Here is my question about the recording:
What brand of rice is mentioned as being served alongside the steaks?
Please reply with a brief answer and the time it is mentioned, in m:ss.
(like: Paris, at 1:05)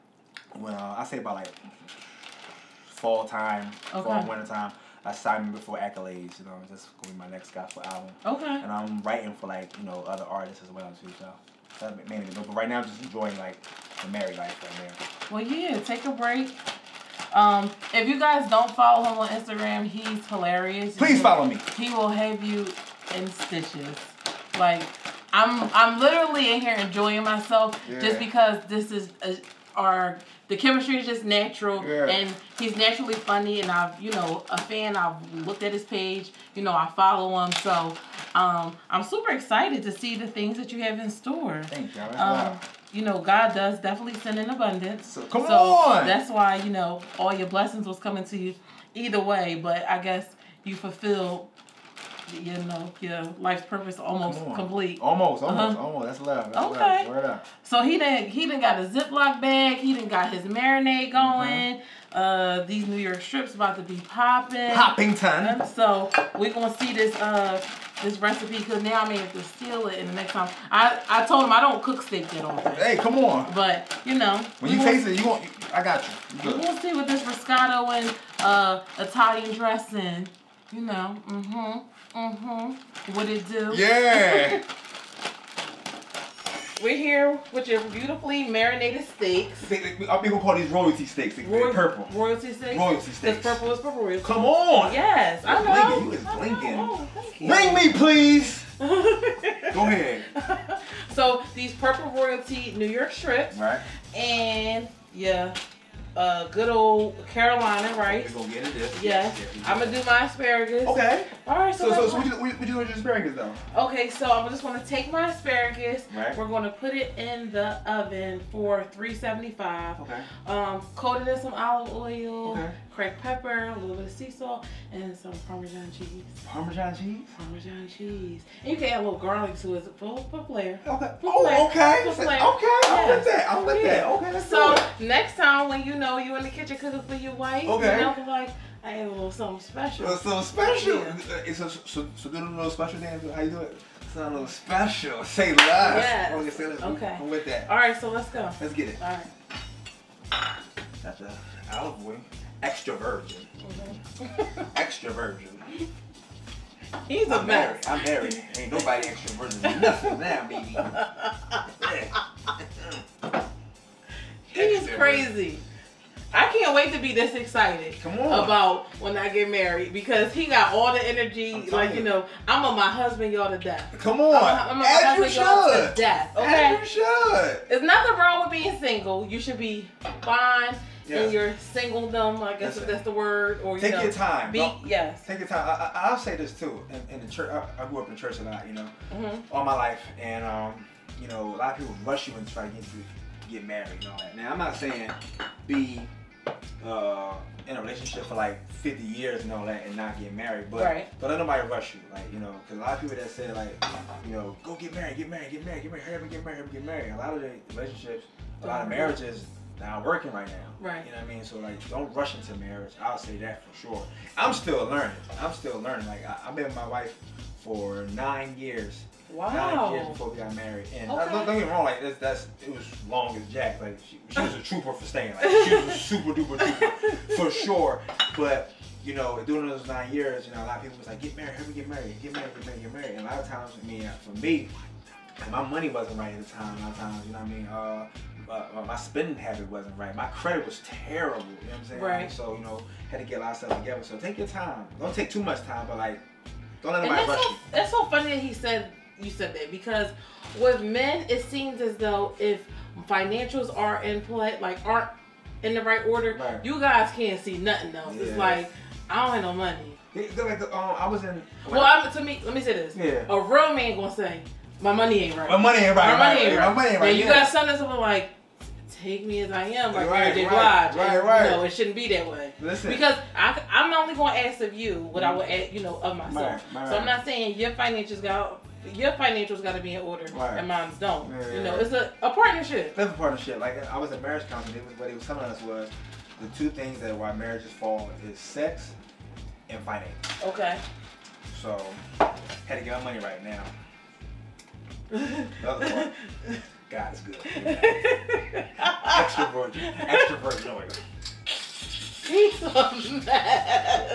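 Carolina, at 1:47.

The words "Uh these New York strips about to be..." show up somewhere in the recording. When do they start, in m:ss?
1:02.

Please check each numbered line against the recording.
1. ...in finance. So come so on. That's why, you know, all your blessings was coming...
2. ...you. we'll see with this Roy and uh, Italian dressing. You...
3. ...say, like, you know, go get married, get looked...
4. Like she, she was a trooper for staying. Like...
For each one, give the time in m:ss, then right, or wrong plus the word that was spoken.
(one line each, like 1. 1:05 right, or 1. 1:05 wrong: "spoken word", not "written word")
1. 0:44 wrong: "abundance", not "finance"
2. 1:16 wrong: "Roscato", not "Roy"
3. 3:23 wrong: "married", not "looked"
4. 3:43 right.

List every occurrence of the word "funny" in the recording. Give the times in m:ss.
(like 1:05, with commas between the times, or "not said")
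0:33, 4:08.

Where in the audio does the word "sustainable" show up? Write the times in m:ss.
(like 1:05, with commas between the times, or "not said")
not said.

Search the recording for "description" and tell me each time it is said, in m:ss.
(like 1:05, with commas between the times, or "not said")
not said.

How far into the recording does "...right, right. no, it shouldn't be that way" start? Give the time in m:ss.
4:30.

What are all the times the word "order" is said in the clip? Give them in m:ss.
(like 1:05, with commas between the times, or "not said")
4:16, 4:40.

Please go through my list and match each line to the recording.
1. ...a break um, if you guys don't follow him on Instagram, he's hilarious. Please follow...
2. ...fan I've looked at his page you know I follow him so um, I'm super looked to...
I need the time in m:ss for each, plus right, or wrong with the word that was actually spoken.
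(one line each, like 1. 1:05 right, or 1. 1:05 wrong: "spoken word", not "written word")
1. 0:16 right
2. 0:34 wrong: "excited", not "looked".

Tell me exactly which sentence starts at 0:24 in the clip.
Like I'm, I'm literally in here enjoying myself yeah.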